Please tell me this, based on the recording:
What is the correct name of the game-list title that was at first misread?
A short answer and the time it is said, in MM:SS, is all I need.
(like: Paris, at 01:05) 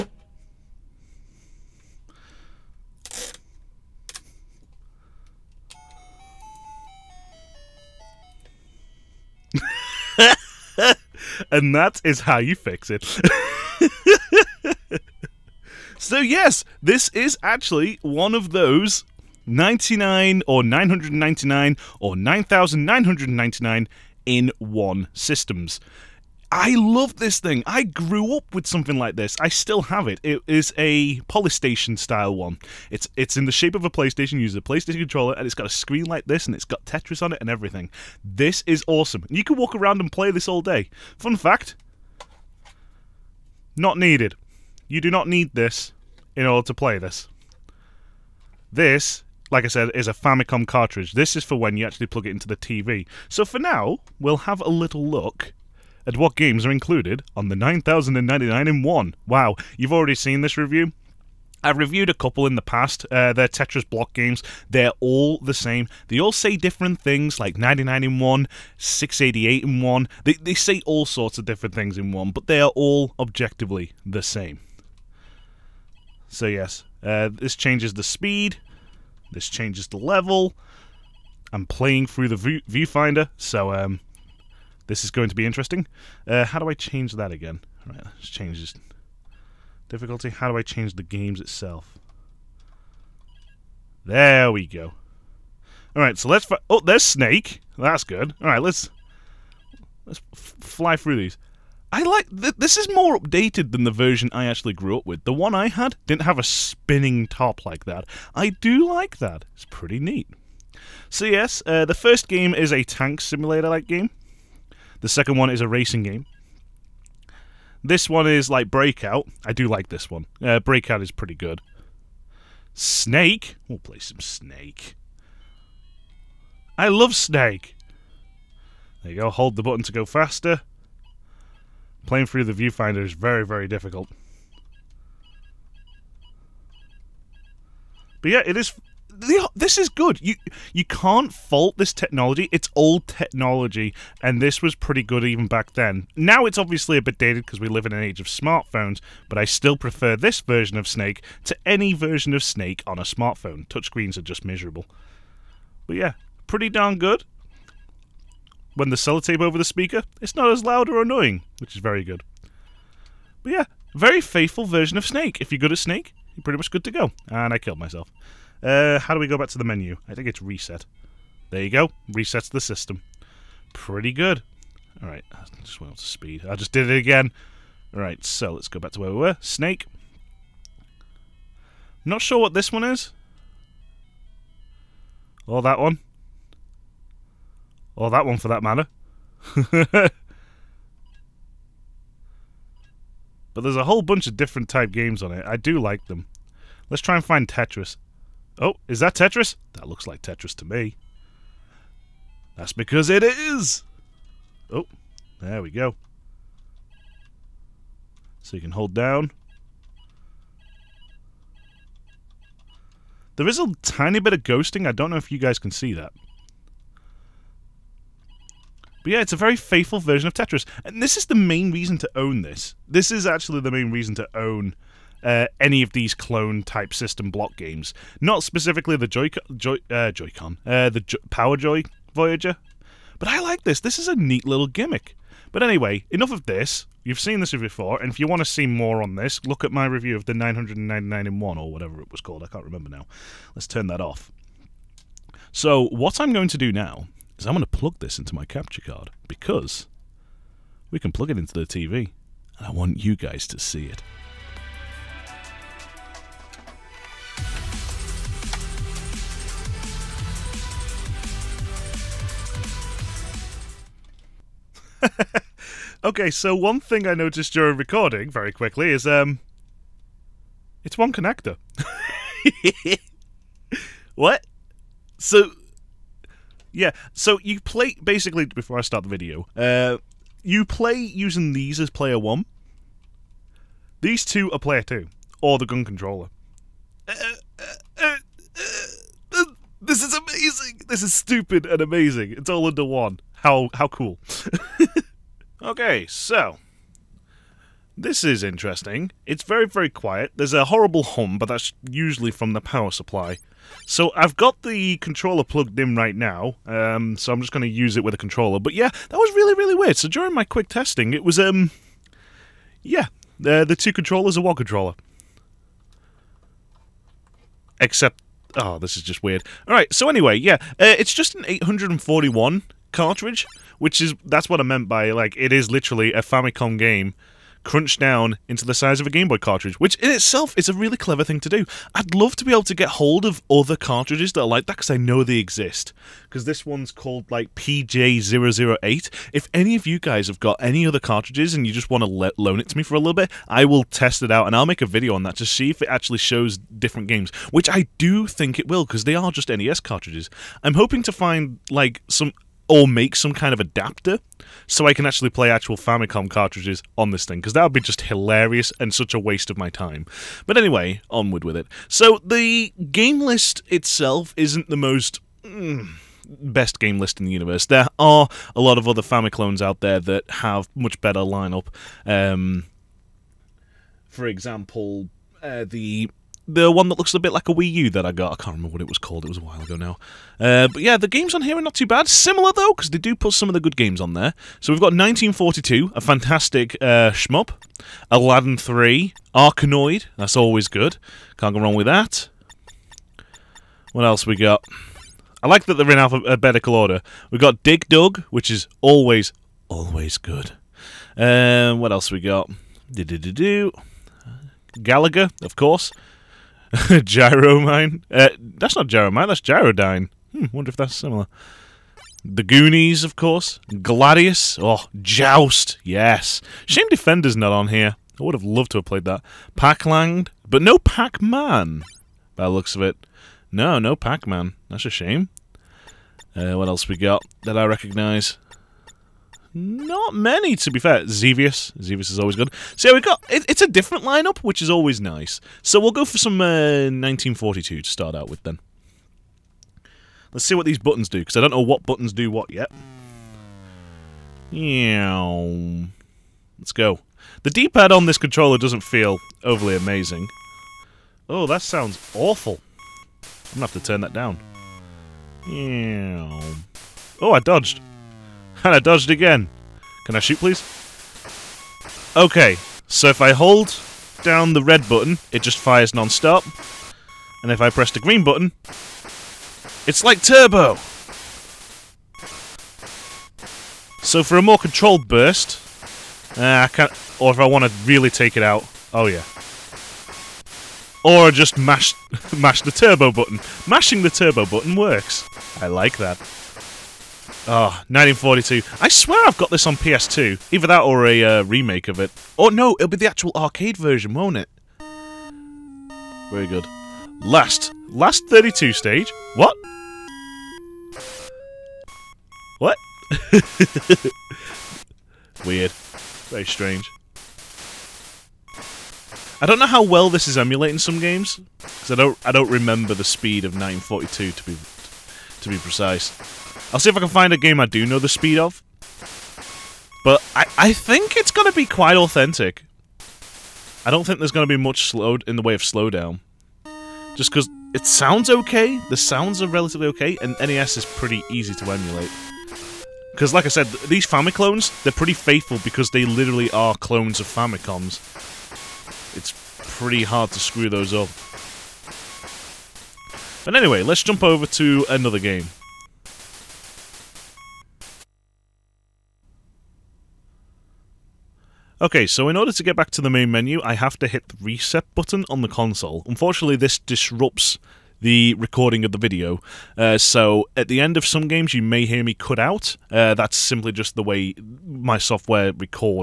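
Gyrodine, at 06:49.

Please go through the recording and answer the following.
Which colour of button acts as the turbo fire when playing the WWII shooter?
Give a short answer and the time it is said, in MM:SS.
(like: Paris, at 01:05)
green, at 07:47.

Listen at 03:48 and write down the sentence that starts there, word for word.
Not specifically the Joy Joy uh, Joy-Con, uh, the Power Joy Voyager, but I like this.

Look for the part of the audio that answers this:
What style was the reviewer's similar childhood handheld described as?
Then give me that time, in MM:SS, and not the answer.
00:31.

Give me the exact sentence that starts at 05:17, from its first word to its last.
Except, oh, this is just weird.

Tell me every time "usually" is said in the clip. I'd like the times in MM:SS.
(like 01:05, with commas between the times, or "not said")
05:01.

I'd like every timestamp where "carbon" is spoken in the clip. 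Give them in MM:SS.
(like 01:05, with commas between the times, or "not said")
not said.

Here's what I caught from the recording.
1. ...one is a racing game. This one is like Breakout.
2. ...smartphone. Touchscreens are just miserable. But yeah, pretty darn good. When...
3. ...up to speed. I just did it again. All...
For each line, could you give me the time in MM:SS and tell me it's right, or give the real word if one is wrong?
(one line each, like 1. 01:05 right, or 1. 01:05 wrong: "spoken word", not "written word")
1. 01:55 right
2. 02:33 right
3. 02:55 right.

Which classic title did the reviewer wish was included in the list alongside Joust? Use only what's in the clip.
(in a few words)
Defender.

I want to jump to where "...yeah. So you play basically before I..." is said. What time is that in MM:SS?
04:36.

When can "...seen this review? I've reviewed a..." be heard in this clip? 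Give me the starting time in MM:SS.
01:00.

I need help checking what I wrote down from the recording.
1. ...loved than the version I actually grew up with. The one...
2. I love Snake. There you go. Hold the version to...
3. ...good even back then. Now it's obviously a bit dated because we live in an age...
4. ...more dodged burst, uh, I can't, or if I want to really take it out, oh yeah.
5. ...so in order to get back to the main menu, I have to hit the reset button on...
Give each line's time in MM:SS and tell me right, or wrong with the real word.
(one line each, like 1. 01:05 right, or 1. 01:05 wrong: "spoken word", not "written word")
1. 01:43 wrong: "updated", not "loved"
2. 02:06 wrong: "button", not "version"
3. 02:25 right
4. 07:54 wrong: "controlled", not "dodged"
5. 09:12 right.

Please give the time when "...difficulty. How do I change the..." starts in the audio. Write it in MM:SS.
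01:29.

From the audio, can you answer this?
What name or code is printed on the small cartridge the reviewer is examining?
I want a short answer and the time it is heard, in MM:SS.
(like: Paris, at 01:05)
PJ008, at 05:37.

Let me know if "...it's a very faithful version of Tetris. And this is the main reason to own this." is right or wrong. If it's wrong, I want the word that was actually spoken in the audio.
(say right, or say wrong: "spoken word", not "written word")
right.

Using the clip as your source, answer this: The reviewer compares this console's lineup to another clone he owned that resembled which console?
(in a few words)
Wii U.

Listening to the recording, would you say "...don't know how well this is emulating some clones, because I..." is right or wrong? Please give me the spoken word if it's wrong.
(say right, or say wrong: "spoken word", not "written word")
wrong: "games", not "clones".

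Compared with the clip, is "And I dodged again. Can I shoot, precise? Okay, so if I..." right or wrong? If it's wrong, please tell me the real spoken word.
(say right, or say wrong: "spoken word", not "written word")
wrong: "please", not "precise".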